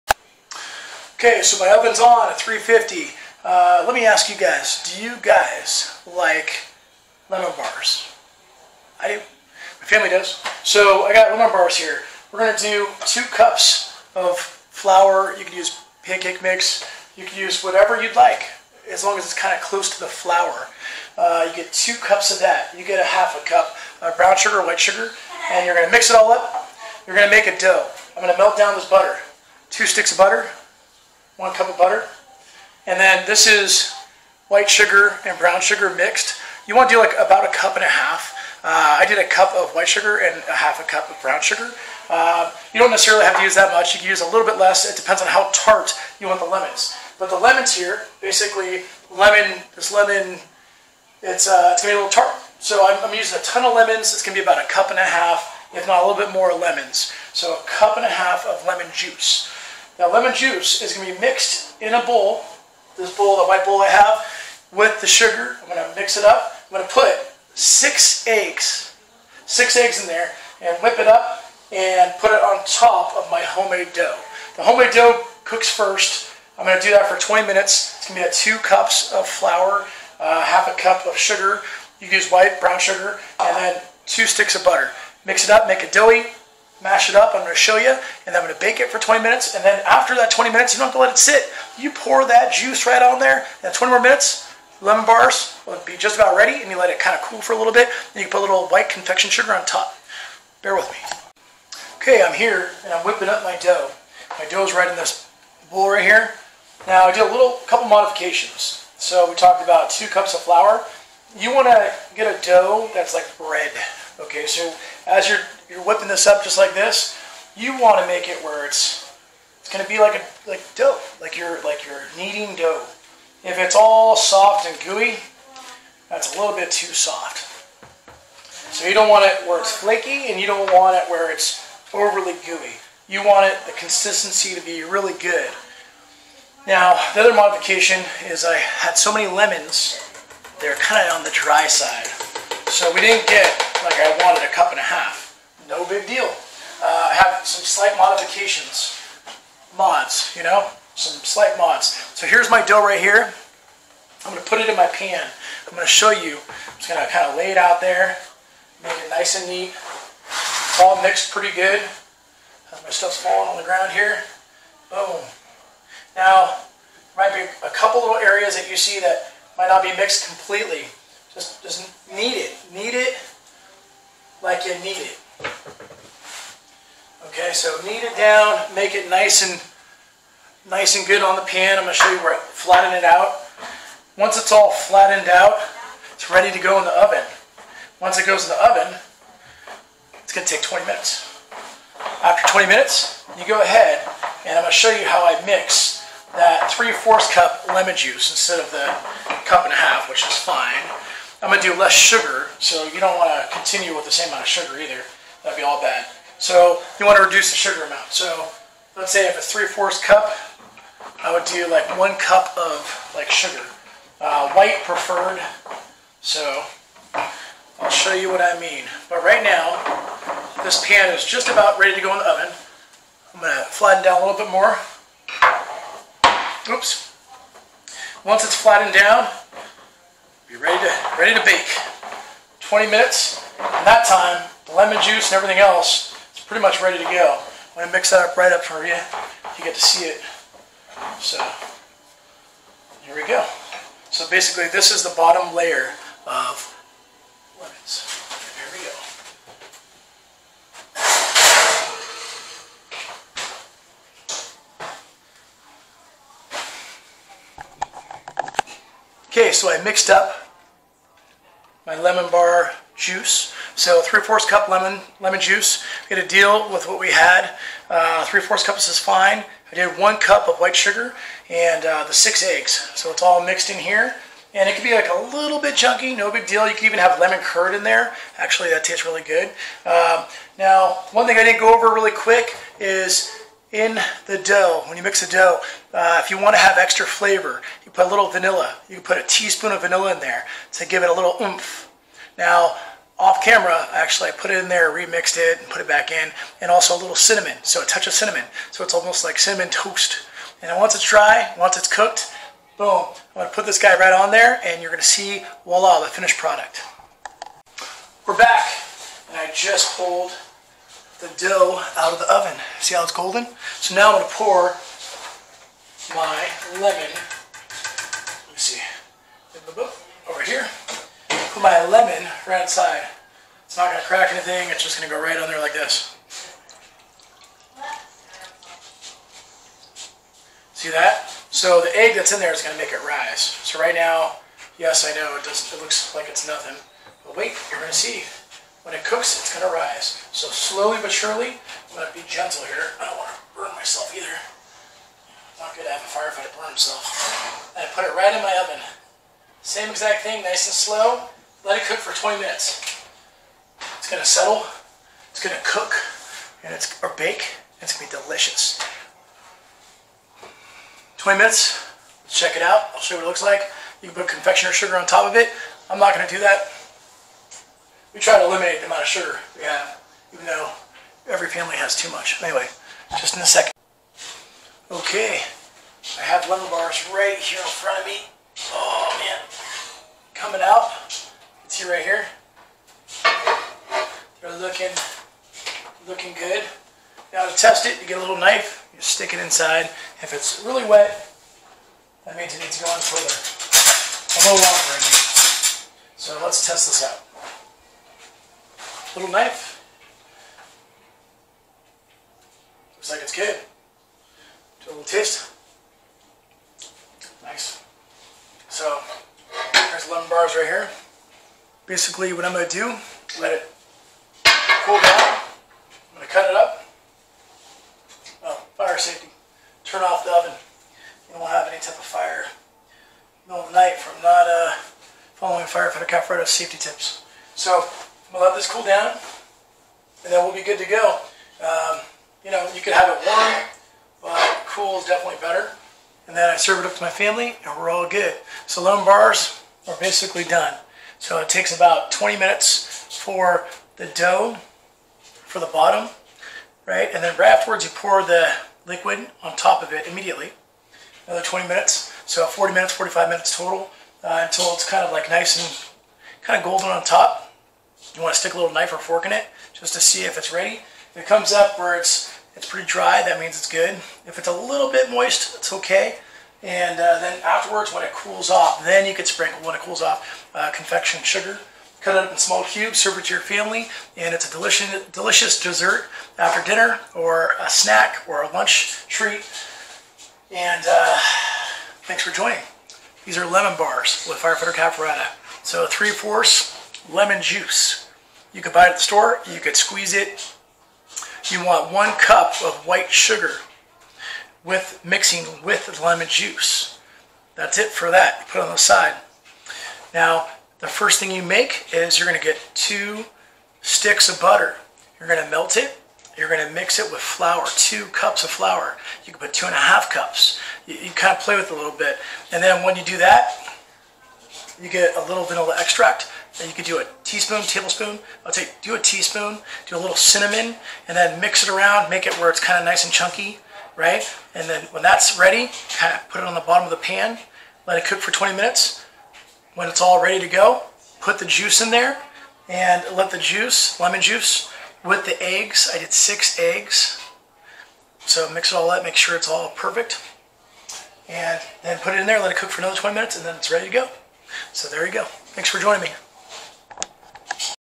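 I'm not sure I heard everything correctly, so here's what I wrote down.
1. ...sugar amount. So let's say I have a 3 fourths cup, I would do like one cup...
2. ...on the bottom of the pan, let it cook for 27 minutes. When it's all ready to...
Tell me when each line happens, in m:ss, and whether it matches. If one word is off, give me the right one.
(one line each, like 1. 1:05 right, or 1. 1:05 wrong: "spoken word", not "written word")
1. 3:27 right
2. 8:46 wrong: "20", not "27".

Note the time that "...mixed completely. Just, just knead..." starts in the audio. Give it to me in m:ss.
2:49.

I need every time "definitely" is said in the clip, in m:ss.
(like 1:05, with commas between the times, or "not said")
7:15.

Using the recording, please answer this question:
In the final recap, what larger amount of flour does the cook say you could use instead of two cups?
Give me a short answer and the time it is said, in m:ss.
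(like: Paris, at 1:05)
2.5 cups, at 8:29.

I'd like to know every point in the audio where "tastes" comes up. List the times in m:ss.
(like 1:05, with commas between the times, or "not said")
4:38, 6:45.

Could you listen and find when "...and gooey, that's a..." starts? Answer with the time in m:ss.
2:04.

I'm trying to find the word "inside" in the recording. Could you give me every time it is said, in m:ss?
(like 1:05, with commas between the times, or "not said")
5:22, 6:29.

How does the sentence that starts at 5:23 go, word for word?
It's not going to crack anything, it's just going to go right on there like this.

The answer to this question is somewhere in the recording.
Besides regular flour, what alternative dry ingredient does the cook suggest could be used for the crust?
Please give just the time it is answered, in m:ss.
0:16.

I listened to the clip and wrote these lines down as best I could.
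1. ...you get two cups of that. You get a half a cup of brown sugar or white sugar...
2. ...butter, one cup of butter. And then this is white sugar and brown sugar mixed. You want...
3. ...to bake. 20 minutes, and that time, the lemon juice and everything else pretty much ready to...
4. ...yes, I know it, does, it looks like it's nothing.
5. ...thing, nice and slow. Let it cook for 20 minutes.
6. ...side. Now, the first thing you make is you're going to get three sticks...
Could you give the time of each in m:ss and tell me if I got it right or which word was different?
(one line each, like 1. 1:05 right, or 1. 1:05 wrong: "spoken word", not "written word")
1. 0:21 right
2. 0:30 right
3. 3:51 right
4. 5:34 right
5. 5:50 right
6. 8:18 wrong: "two", not "three".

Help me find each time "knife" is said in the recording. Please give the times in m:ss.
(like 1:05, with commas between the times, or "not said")
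6:28, 6:39, 7:38.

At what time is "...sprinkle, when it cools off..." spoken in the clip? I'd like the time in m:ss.
7:49.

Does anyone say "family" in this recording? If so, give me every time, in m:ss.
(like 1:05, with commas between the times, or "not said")
0:09, 6:11, 7:17, 7:53.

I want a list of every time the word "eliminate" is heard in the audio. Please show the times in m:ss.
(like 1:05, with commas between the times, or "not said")
6:08.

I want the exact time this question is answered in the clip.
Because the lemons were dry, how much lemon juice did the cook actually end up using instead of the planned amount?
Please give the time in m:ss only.
3:16.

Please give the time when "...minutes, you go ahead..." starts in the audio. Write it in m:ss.
3:12.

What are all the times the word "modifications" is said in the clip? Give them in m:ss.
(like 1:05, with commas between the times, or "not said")
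1:47, 2:17, 2:27.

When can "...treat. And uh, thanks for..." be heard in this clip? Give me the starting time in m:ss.
7:59.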